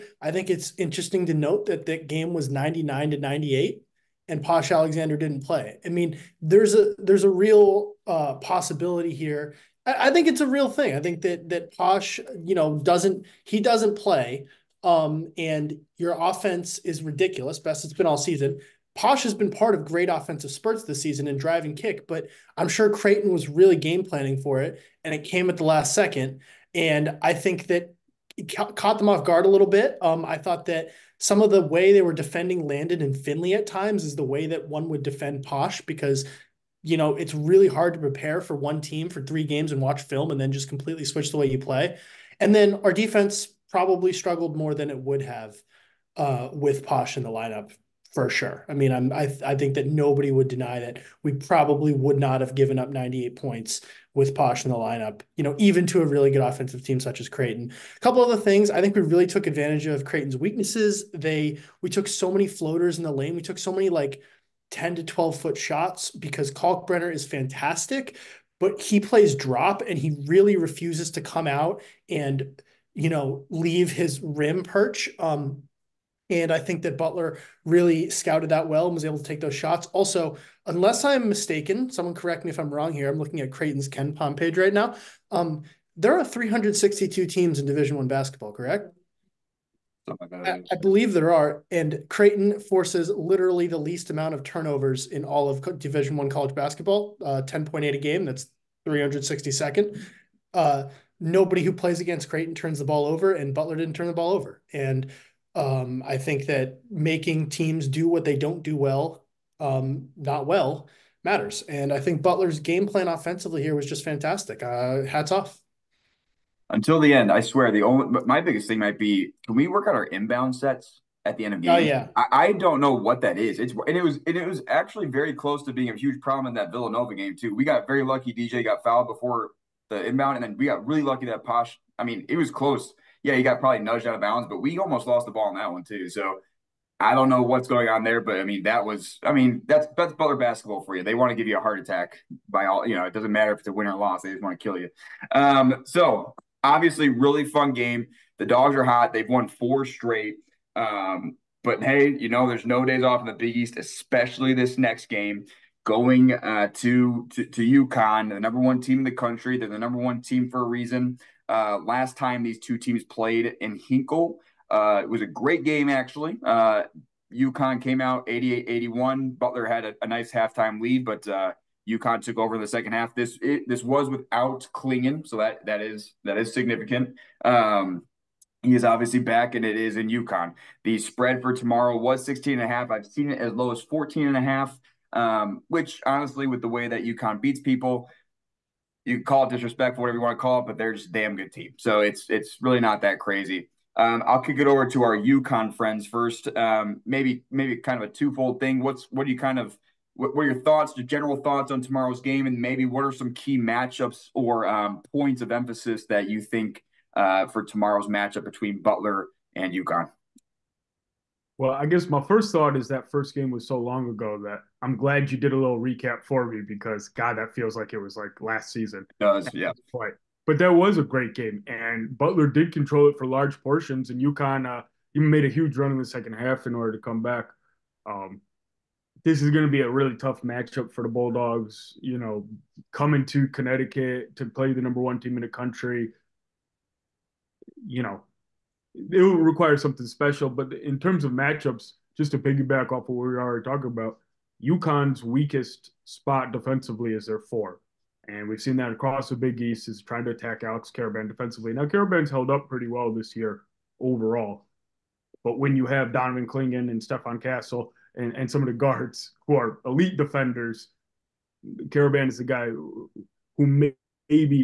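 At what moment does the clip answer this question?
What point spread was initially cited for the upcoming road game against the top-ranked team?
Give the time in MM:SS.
03:02.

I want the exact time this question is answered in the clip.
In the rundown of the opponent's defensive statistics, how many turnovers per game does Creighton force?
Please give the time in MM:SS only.
01:37.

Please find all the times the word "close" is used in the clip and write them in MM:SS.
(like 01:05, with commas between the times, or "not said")
02:05, 02:12.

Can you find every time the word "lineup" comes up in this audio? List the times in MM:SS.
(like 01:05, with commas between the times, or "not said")
00:47, 00:54.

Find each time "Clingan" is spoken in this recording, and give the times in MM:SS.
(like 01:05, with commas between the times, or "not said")
02:54, 04:16.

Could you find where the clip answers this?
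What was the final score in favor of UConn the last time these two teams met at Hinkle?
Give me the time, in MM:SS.
02:48.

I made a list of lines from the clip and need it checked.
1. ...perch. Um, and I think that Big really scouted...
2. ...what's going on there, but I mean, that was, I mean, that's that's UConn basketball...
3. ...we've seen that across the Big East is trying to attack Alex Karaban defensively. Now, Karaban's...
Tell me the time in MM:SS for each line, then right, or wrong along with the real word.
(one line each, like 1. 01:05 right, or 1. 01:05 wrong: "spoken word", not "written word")
1. 01:14 wrong: "Butler", not "Big"
2. 02:17 wrong: "Butler", not "UConn"
3. 04:08 right.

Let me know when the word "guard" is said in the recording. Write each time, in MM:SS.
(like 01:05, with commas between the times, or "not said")
00:29, 04:18.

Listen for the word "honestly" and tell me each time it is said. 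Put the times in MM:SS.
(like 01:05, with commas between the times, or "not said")
03:06.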